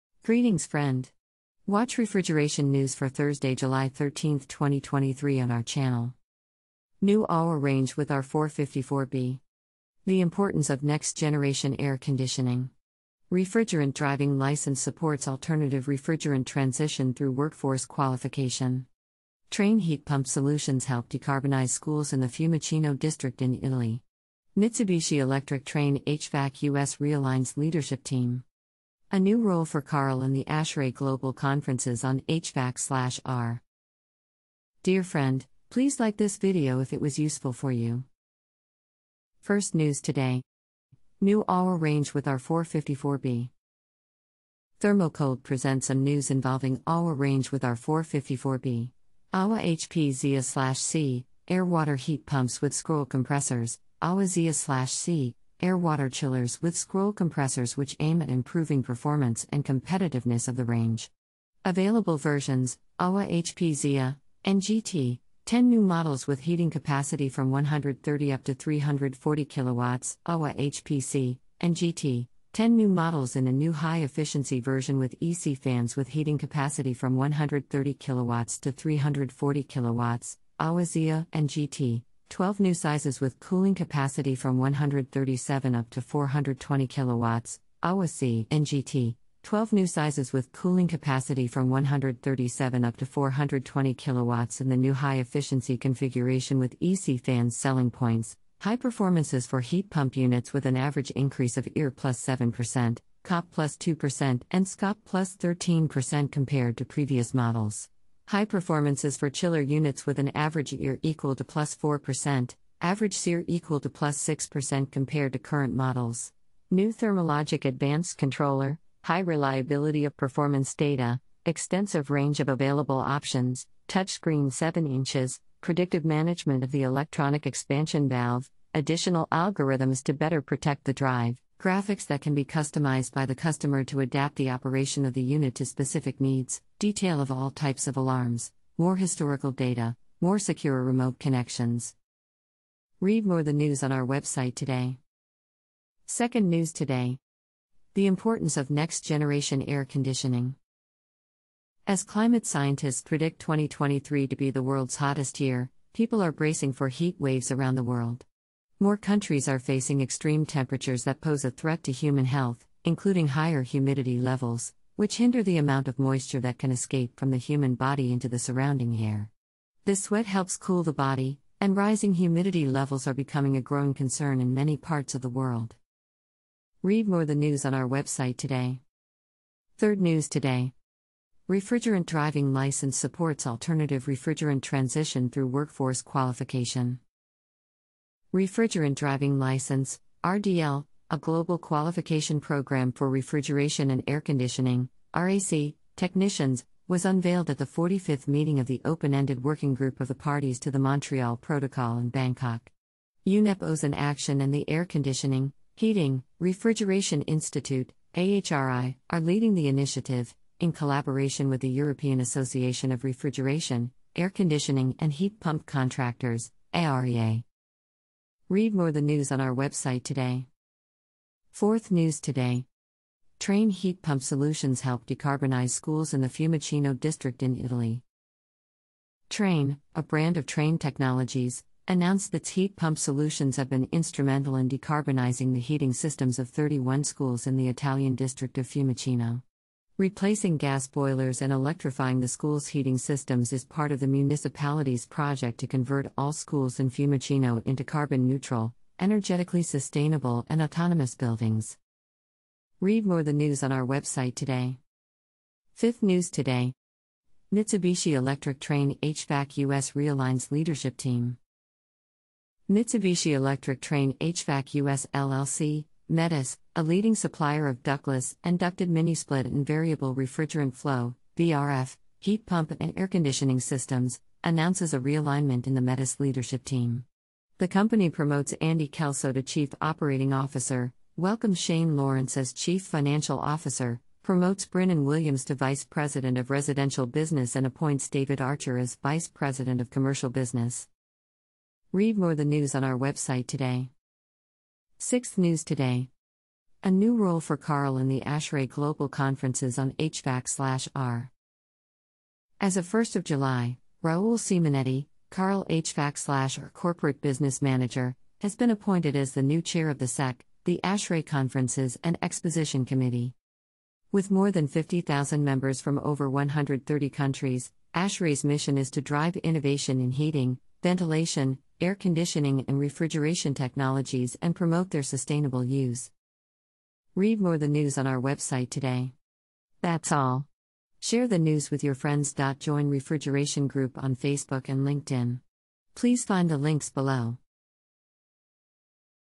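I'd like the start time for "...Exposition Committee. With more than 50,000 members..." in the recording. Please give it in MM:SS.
05:12.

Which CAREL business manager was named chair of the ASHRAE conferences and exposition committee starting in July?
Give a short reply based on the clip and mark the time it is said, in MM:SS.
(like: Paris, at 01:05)
Raul Simonetti, at 05:04.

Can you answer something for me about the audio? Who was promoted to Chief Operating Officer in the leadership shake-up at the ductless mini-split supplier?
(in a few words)
Andy Kelso.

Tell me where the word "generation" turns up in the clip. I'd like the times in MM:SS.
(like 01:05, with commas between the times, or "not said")
00:11, 02:29.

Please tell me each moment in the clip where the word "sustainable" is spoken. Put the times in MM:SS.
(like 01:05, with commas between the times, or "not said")
04:09, 05:25.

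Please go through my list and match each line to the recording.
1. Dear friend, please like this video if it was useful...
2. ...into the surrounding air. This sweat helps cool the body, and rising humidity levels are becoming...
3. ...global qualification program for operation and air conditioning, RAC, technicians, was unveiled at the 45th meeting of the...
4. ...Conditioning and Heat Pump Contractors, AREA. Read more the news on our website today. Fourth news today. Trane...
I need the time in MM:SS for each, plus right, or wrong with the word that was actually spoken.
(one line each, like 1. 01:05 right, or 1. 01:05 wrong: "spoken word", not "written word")
1. 00:34 right
2. 02:48 right
3. 03:11 wrong: "refrigeration", not "operation"
4. 03:34 right.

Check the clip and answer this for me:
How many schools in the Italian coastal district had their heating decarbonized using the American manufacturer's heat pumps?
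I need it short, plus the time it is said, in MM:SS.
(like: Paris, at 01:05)
31, at 03:56.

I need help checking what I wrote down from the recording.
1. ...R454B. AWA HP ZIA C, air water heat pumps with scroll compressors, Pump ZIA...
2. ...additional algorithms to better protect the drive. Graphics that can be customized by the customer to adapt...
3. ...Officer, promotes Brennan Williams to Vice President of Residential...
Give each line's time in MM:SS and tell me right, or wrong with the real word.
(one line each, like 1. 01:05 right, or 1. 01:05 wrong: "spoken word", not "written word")
1. 00:47 wrong: "AWA", not "Pump"
2. 02:08 right
3. 04:43 right.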